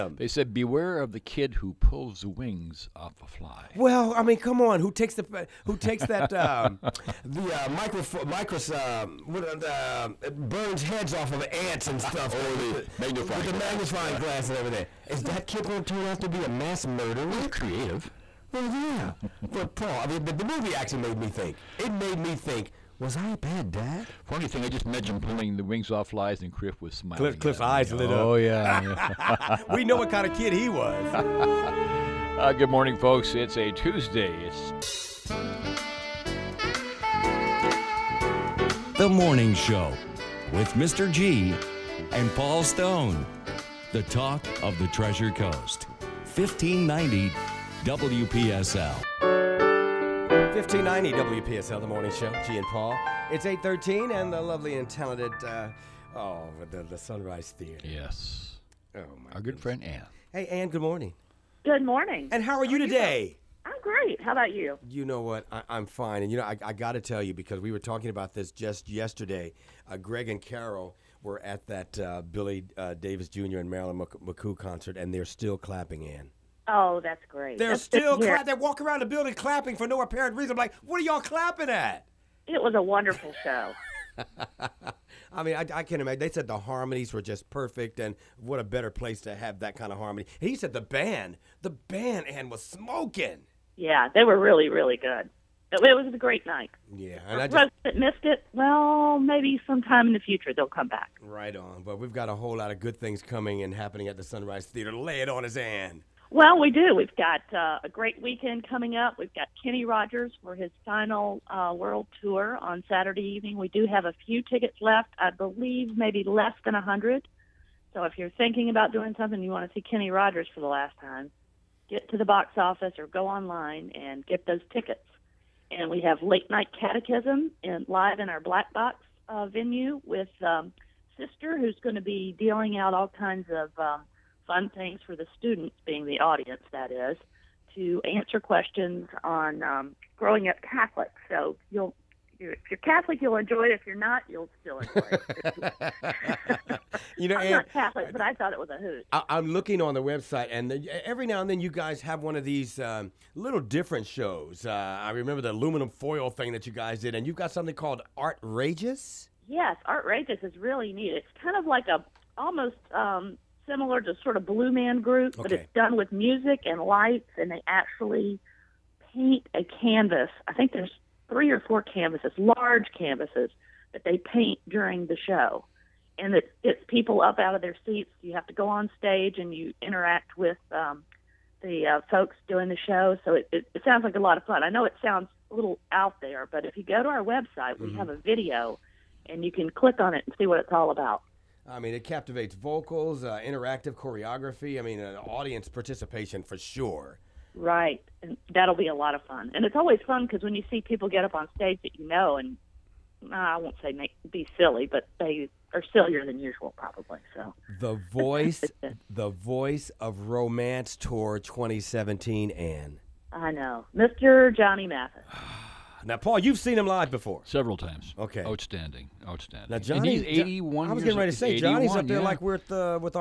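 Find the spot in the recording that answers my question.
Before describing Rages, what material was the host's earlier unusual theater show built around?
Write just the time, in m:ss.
2:35.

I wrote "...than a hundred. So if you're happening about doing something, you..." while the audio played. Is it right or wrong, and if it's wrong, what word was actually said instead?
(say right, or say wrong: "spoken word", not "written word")
wrong: "thinking", not "happening".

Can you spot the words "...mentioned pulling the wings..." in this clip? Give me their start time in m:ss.
0:24.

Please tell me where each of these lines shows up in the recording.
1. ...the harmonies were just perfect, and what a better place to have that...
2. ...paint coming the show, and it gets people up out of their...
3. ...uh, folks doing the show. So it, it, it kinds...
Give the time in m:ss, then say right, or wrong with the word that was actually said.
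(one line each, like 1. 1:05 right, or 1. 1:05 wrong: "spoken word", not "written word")
1. 1:26 right
2. 2:54 wrong: "during", not "coming"
3. 3:01 wrong: "sounds", not "kinds".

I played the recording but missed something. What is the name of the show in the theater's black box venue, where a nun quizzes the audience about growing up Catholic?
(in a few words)
Late Night Catechism.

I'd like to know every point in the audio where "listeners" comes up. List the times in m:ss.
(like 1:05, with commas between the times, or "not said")
not said.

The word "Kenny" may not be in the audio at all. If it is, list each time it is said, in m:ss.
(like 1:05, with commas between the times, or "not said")
1:49, 1:59.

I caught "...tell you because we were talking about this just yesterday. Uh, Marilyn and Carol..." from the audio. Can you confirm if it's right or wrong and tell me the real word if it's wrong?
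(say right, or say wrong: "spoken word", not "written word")
wrong: "Greg", not "Marilyn".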